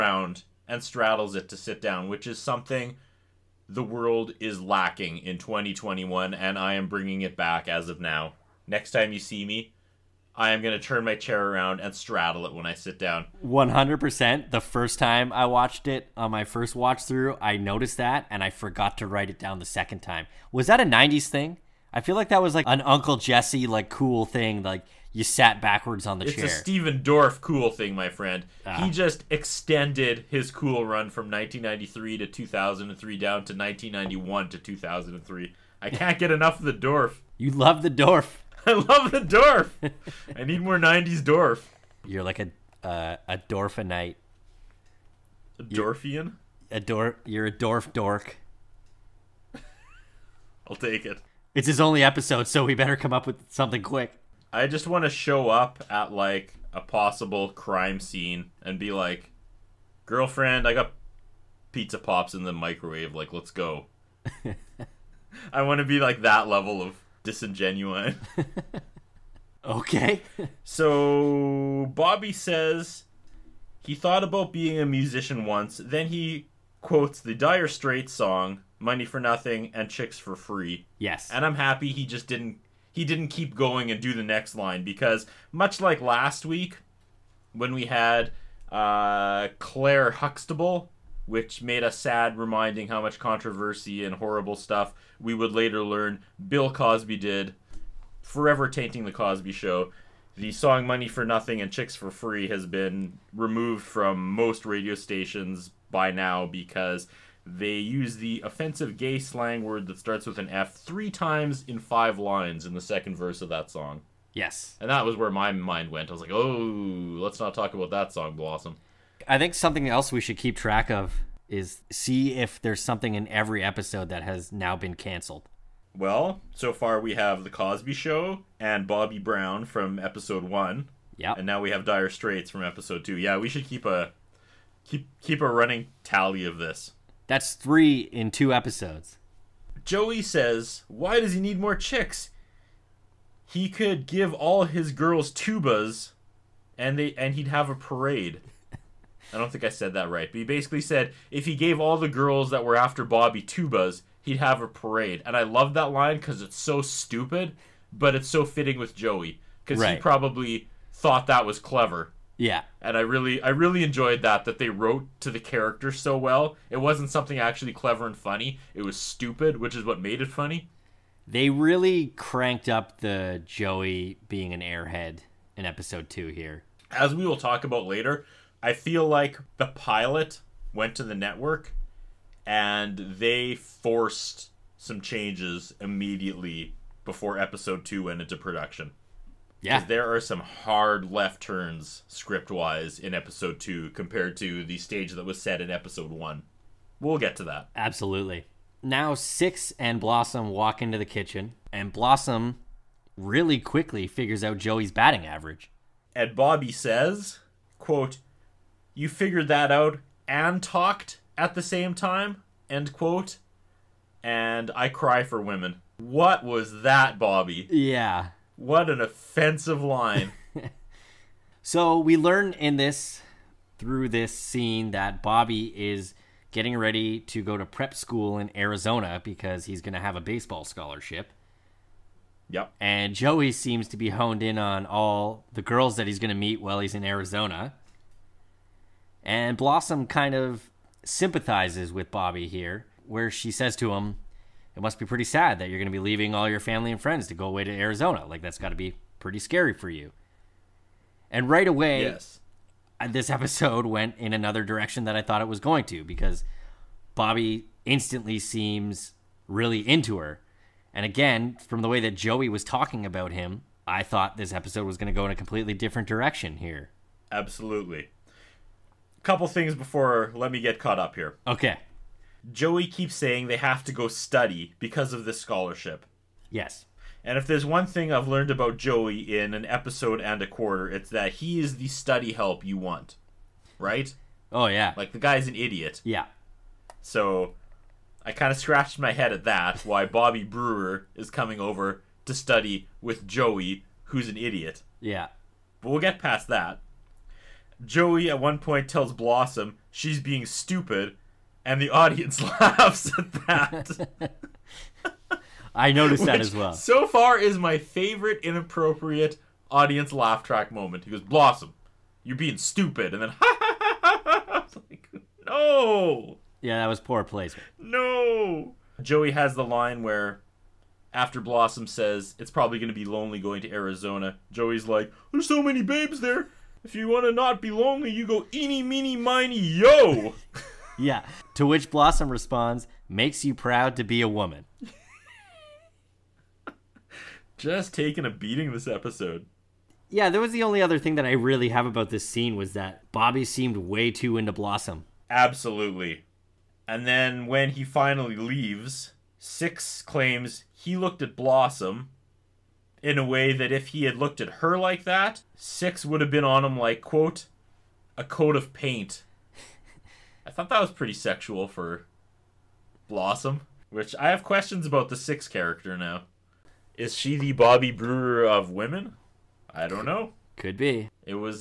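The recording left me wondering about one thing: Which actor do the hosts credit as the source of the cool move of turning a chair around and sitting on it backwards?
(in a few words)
Stephen Dorff.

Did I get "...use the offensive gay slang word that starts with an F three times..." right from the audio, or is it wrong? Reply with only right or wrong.
right.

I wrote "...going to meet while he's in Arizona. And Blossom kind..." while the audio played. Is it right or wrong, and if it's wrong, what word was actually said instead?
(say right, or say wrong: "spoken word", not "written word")
right.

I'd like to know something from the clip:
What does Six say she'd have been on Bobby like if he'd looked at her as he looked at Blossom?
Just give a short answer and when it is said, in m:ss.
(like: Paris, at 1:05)
a coat of paint, at 5:58.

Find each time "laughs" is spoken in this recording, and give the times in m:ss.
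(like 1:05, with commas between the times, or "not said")
5:02, 5:10.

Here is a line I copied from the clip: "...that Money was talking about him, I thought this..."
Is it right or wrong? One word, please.
wrong.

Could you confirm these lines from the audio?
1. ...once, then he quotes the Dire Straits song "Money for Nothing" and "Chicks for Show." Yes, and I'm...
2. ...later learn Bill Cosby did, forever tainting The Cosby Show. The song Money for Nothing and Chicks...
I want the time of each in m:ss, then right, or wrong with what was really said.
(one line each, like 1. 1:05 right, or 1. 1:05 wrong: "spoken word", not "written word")
1. 1:15 wrong: "Free", not "Show"
2. 1:35 right.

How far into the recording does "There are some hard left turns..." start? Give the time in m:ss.
3:09.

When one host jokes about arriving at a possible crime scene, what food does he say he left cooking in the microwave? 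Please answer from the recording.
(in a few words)
pizza pops.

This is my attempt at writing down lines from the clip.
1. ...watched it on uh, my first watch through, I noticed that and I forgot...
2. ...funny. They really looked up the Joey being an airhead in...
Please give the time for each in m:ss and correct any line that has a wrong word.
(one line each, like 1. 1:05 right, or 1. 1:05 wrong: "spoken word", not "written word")
1. 0:15 right
2. 2:50 wrong: "cranked", not "looked".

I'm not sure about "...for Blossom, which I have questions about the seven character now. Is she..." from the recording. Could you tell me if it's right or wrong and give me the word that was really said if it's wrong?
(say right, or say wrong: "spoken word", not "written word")
wrong: "six", not "seven".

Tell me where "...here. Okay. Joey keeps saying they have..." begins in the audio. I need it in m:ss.
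4:31.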